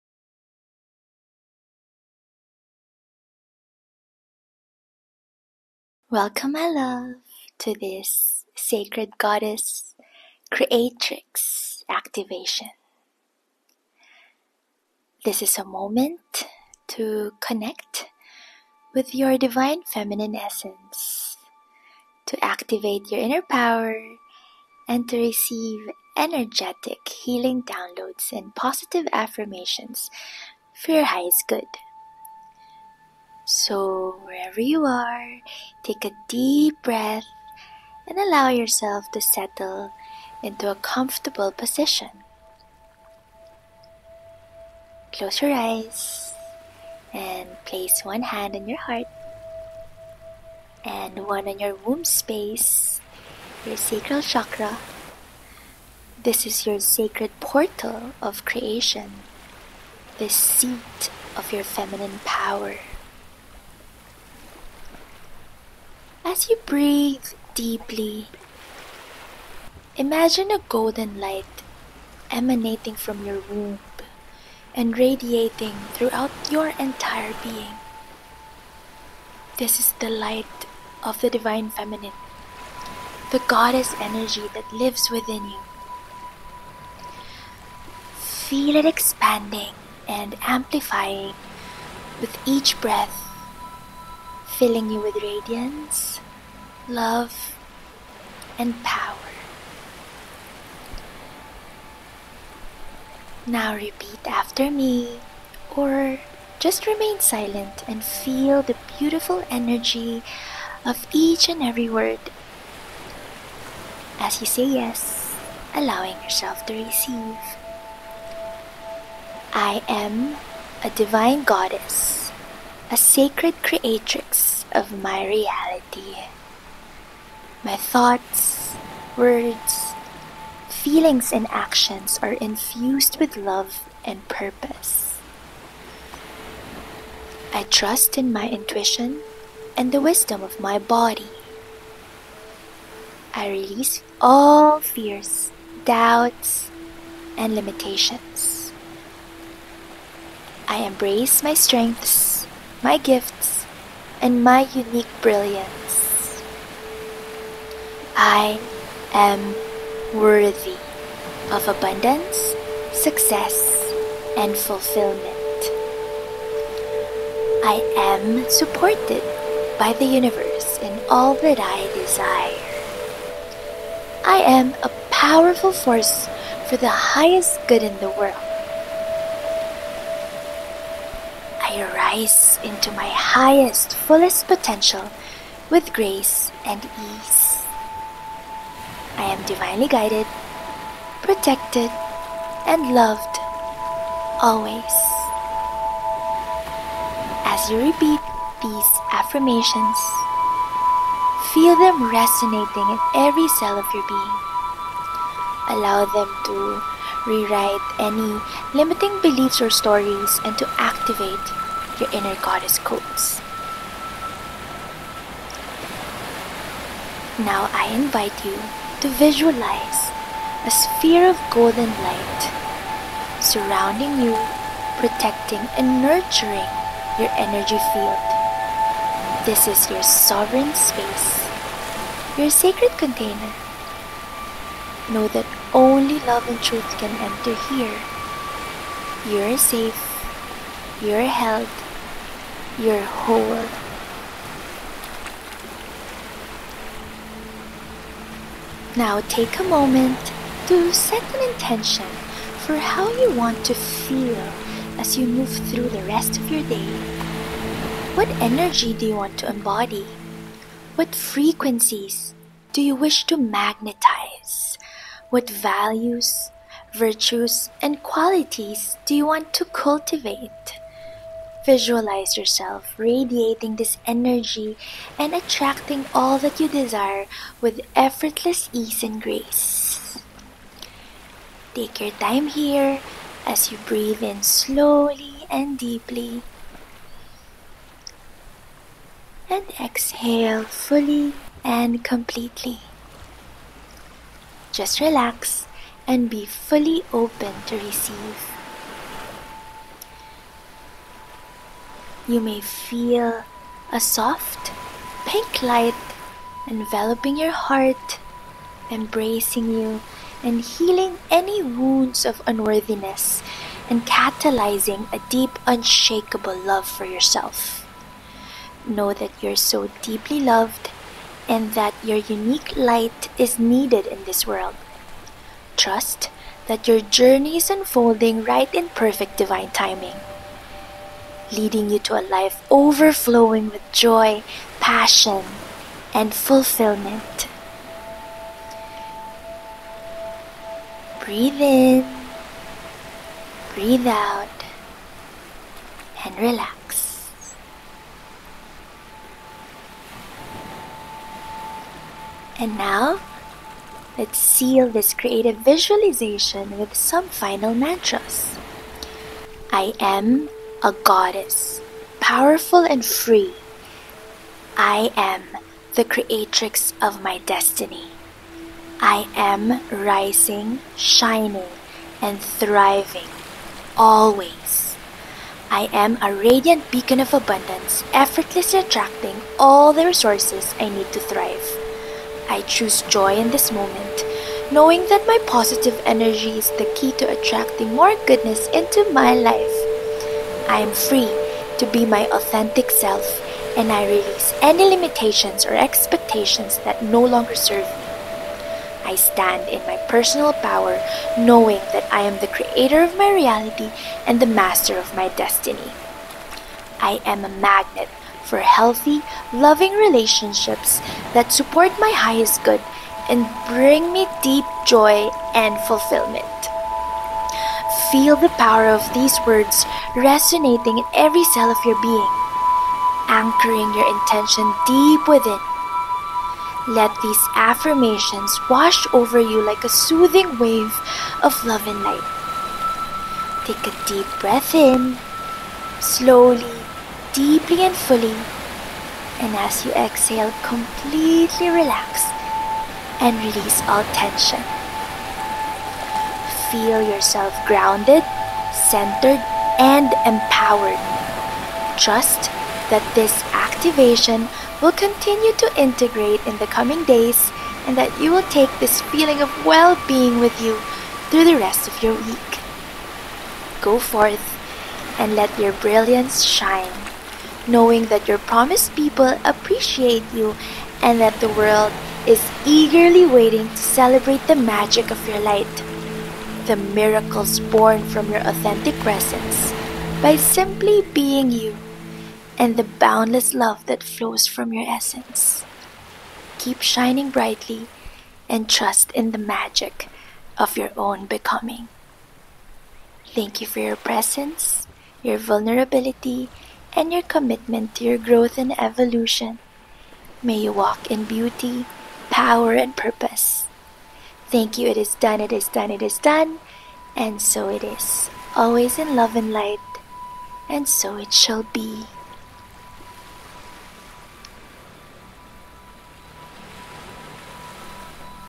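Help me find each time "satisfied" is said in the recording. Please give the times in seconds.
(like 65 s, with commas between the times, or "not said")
not said.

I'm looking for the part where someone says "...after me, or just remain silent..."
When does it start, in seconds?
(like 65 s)
104 s.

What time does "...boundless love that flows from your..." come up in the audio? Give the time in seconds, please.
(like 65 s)
482 s.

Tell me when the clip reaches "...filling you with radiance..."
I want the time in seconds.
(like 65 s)
94 s.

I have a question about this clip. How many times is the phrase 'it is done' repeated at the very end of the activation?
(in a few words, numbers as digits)
3.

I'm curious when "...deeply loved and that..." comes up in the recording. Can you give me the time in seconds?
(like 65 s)
320 s.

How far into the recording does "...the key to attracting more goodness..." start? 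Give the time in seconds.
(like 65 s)
386 s.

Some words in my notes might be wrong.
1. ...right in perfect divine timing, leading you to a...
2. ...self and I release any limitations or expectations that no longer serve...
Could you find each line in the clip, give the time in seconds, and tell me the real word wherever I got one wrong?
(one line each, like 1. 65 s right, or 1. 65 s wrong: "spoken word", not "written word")
1. 328 s right
2. 392 s right.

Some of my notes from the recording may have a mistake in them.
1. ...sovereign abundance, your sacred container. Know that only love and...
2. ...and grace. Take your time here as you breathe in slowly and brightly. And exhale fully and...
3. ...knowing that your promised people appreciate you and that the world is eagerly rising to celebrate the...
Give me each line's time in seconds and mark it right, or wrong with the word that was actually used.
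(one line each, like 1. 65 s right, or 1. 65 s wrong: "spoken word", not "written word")
1. 230 s wrong: "space", not "abundance"
2. 279 s wrong: "deeply", not "brightly"
3. 467 s wrong: "waiting", not "rising".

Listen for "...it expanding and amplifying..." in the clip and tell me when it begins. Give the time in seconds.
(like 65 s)
88 s.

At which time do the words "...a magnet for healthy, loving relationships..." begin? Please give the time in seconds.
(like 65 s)
407 s.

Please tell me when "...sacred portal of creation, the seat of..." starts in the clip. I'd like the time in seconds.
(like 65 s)
56 s.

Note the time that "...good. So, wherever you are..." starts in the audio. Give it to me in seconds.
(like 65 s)
31 s.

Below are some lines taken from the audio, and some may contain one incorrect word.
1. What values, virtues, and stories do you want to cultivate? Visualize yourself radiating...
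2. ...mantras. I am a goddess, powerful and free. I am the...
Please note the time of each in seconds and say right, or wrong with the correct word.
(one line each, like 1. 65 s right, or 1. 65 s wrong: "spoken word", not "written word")
1. 265 s wrong: "qualities", not "stories"
2. 357 s right.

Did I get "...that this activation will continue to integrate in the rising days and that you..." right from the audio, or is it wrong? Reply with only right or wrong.
wrong.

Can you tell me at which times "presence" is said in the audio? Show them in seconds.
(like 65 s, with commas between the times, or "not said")
478 s, 493 s.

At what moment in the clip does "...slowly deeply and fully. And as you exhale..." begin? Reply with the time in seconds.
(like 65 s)
436 s.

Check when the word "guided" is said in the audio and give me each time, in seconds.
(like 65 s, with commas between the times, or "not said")
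189 s.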